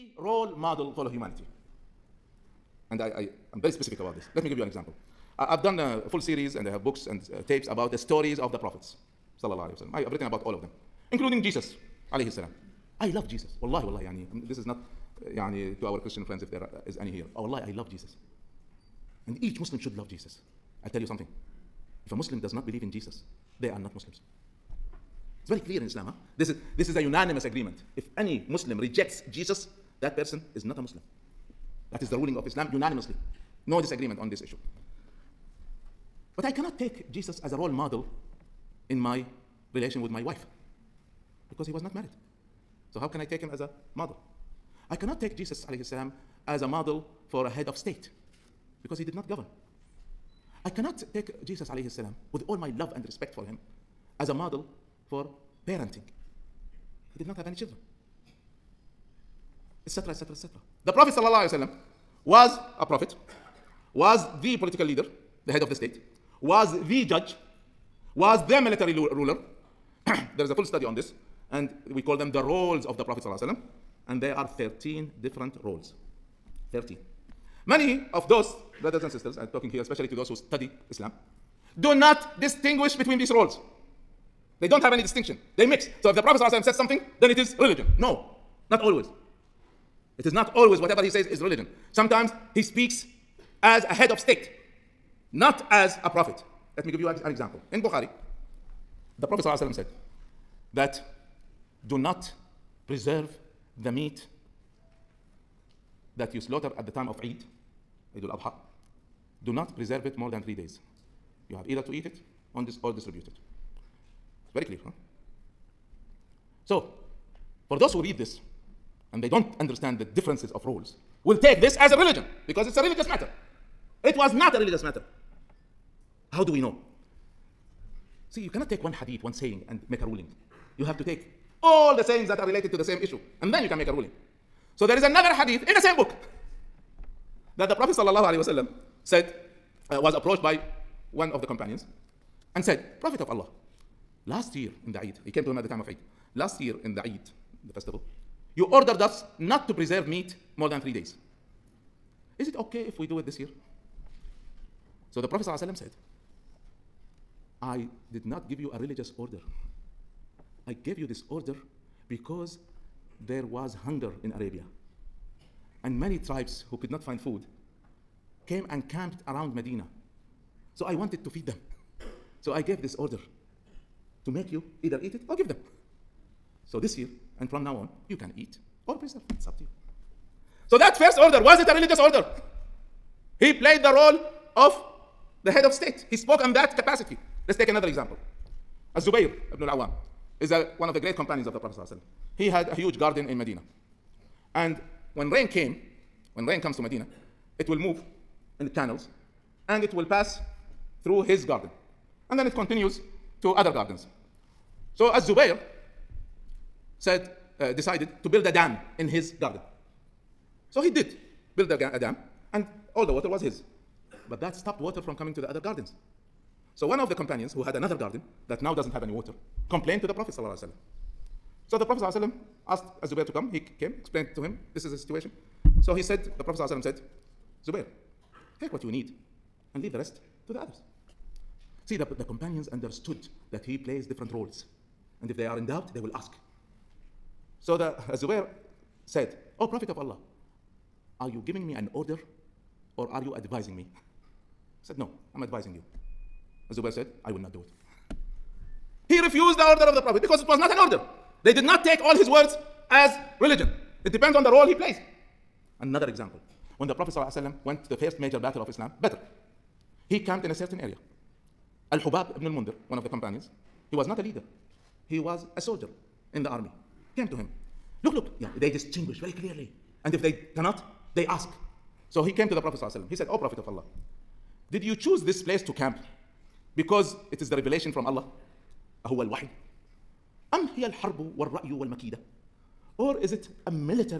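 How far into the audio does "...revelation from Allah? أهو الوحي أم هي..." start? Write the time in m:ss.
4:37.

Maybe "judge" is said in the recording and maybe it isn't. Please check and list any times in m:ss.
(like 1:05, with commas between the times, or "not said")
1:07.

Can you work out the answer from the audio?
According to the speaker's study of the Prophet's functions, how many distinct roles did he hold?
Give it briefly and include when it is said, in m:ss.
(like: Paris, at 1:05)
13, at 1:14.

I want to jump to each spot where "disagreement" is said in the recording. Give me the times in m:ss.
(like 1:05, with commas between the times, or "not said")
0:33.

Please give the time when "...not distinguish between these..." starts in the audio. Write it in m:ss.
1:21.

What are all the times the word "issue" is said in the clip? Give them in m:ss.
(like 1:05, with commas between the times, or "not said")
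0:34, 2:13.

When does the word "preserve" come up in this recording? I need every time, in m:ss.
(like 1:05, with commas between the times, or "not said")
1:42, 1:49, 2:29, 2:58.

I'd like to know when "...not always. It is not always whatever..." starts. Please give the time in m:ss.
1:28.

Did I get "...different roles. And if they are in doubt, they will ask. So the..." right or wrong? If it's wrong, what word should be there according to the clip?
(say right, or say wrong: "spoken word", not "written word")
right.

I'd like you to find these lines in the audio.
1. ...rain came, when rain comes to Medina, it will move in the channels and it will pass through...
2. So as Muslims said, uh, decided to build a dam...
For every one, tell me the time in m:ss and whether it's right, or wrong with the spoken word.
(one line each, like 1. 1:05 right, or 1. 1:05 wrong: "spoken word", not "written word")
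1. 3:15 right
2. 3:24 wrong: "Zubair", not "Muslims".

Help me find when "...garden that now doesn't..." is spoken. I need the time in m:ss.
3:37.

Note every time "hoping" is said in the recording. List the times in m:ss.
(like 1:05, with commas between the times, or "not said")
not said.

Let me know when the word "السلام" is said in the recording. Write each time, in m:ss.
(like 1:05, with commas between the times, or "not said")
0:12, 0:45, 0:51.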